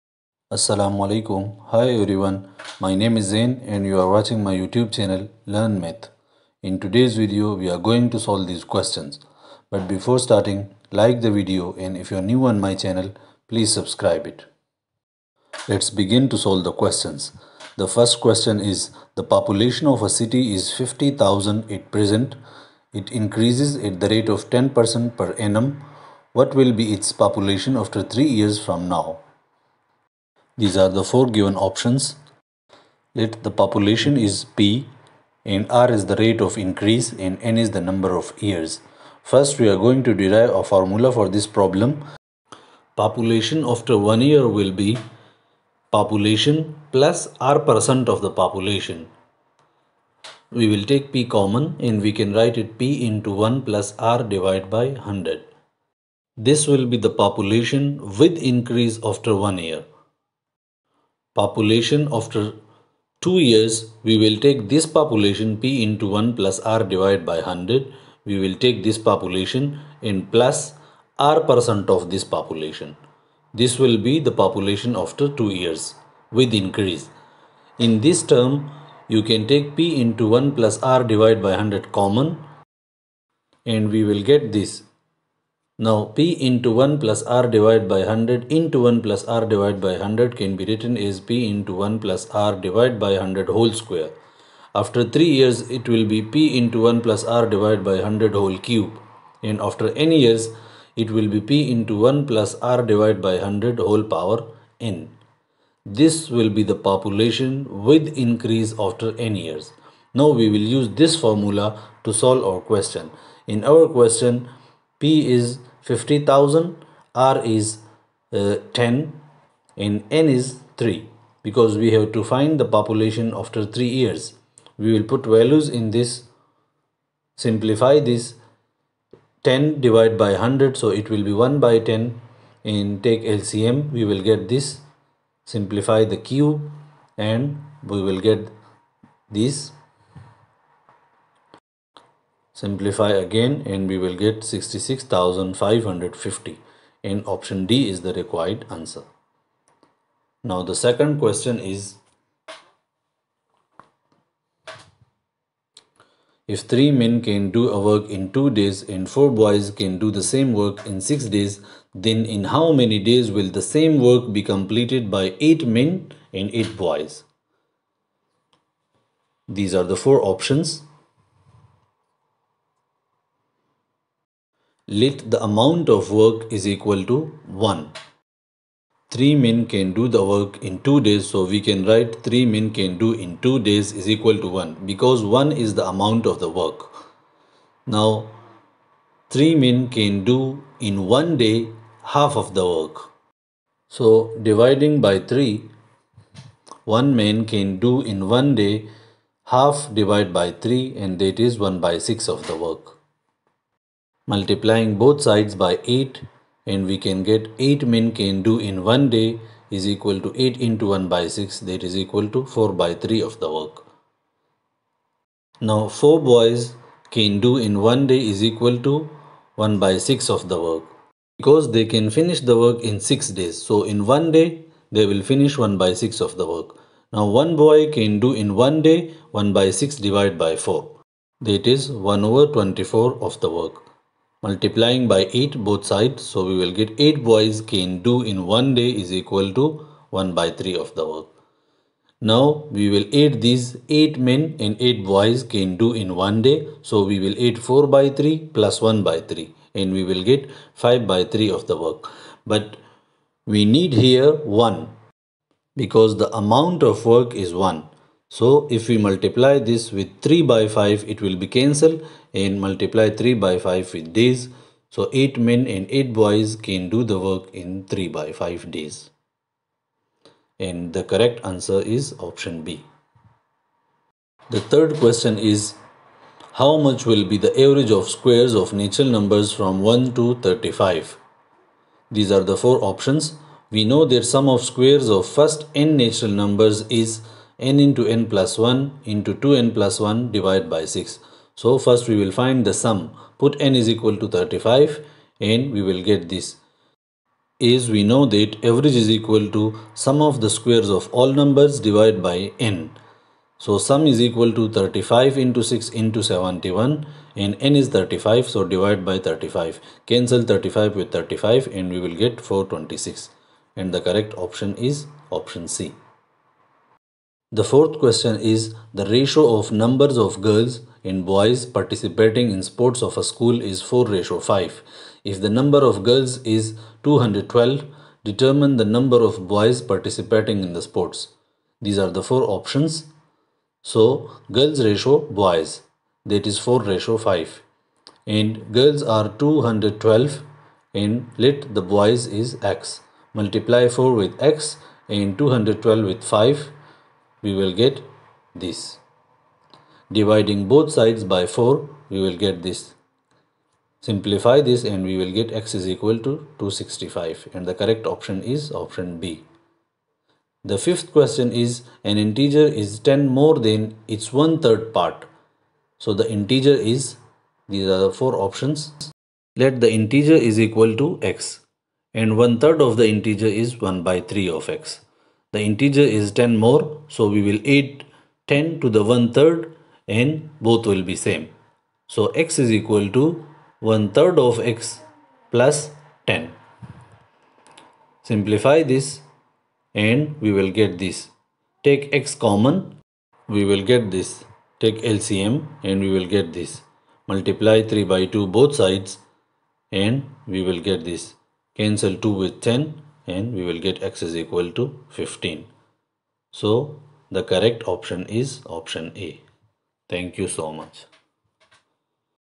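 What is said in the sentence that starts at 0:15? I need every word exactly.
Let's begin to solve the questions.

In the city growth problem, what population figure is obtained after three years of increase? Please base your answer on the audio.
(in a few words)
66,550.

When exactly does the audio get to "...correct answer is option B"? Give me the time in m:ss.
4:31.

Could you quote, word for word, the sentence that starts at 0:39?
First we are going to derive a formula for this problem.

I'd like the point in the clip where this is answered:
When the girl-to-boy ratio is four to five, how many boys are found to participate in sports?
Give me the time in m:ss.
5:56.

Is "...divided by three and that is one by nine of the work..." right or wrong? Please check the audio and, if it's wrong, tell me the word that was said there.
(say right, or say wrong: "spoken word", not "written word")
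wrong: "six", not "nine".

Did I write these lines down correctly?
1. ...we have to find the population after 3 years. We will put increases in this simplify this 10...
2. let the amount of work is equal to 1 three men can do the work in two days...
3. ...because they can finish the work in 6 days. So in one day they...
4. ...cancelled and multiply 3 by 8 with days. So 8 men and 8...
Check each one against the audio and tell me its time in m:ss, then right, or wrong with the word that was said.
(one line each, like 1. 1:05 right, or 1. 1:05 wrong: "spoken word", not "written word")
1. 2:01 wrong: "values", not "increases"
2. 2:54 right
3. 3:41 right
4. 4:21 wrong: "5", not "8".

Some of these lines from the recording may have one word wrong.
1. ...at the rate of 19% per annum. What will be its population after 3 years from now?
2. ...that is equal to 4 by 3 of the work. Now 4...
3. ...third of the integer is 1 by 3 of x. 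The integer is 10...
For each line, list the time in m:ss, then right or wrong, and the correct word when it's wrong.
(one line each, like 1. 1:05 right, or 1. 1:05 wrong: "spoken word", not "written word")
1. 0:23 wrong: "10", not "19"
2. 3:31 right
3. 6:12 right.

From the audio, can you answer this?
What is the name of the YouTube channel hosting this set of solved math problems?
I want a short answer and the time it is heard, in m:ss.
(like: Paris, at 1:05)
Learn Math, at 0:05.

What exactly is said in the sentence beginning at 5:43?
Multiply 4 with x and 212 with 5 we will get this.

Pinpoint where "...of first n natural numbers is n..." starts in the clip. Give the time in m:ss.
4:45.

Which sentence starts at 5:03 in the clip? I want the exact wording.
So sum is equal to 35 into 6 into 71 and n is 35 so divide by 35.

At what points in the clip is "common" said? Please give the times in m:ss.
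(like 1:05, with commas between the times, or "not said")
0:51, 1:22, 6:32.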